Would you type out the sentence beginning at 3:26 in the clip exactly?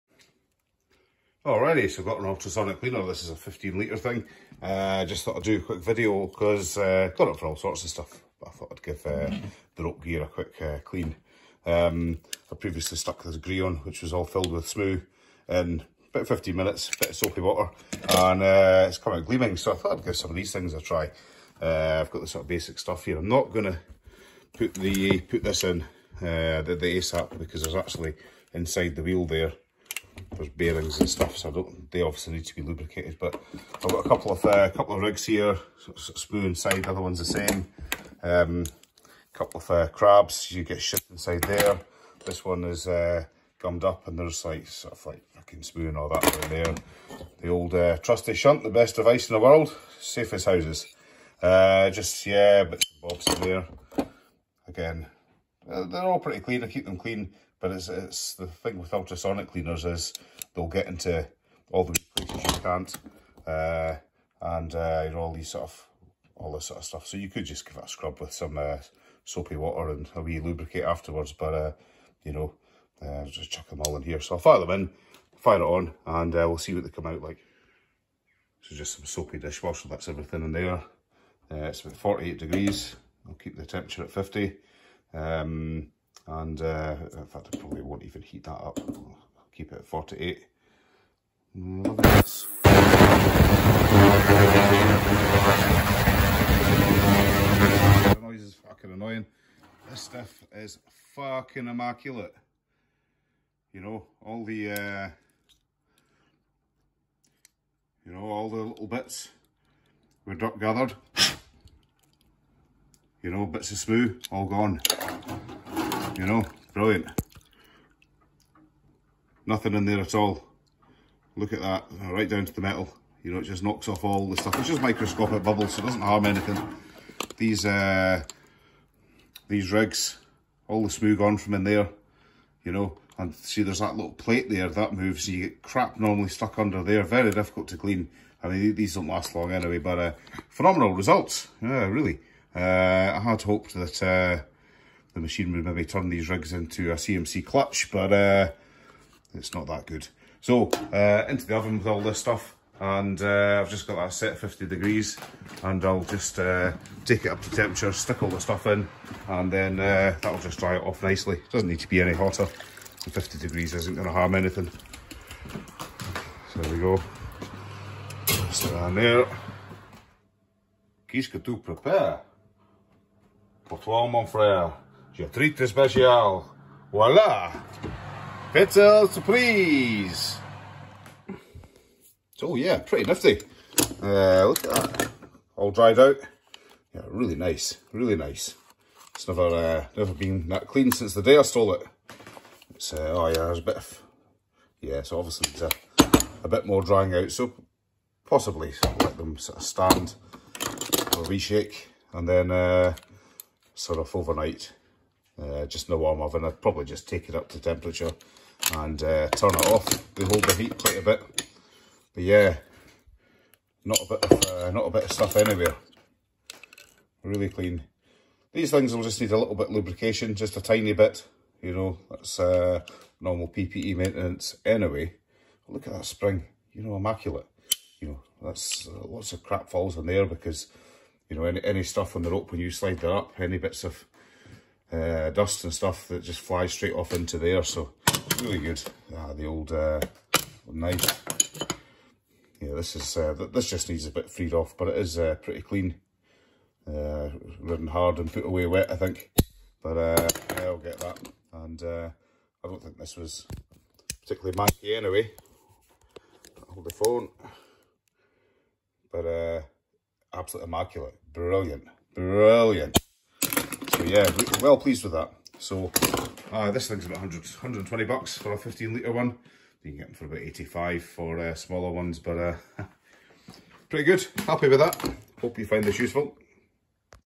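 I'd probably just take it up to temperature and uh, turn it off.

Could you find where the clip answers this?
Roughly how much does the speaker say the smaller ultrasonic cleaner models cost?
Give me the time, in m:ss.
4:30.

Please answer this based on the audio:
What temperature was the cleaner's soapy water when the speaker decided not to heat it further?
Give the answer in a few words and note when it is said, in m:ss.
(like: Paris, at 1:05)
48 degrees, at 1:21.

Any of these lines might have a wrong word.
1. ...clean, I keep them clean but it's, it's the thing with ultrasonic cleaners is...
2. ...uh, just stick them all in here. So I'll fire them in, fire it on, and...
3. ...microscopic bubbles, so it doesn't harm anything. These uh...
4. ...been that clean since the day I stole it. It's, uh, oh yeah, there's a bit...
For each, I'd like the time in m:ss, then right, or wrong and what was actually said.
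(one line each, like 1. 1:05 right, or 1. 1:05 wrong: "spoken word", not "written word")
1. 0:56 right
2. 1:12 wrong: "chuck", not "stick"
3. 2:04 right
4. 3:10 right.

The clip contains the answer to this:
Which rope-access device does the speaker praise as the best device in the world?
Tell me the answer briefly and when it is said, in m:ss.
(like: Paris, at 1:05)
shunt, at 0:48.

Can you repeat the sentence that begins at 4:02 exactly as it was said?
Yeah, this is uh, this just needs a bit freed off, but it is uh, pretty clean.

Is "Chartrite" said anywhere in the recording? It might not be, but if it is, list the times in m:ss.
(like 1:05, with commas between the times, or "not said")
2:55.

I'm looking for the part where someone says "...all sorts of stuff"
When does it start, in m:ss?
0:07.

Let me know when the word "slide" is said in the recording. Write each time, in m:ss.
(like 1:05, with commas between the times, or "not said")
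3:52.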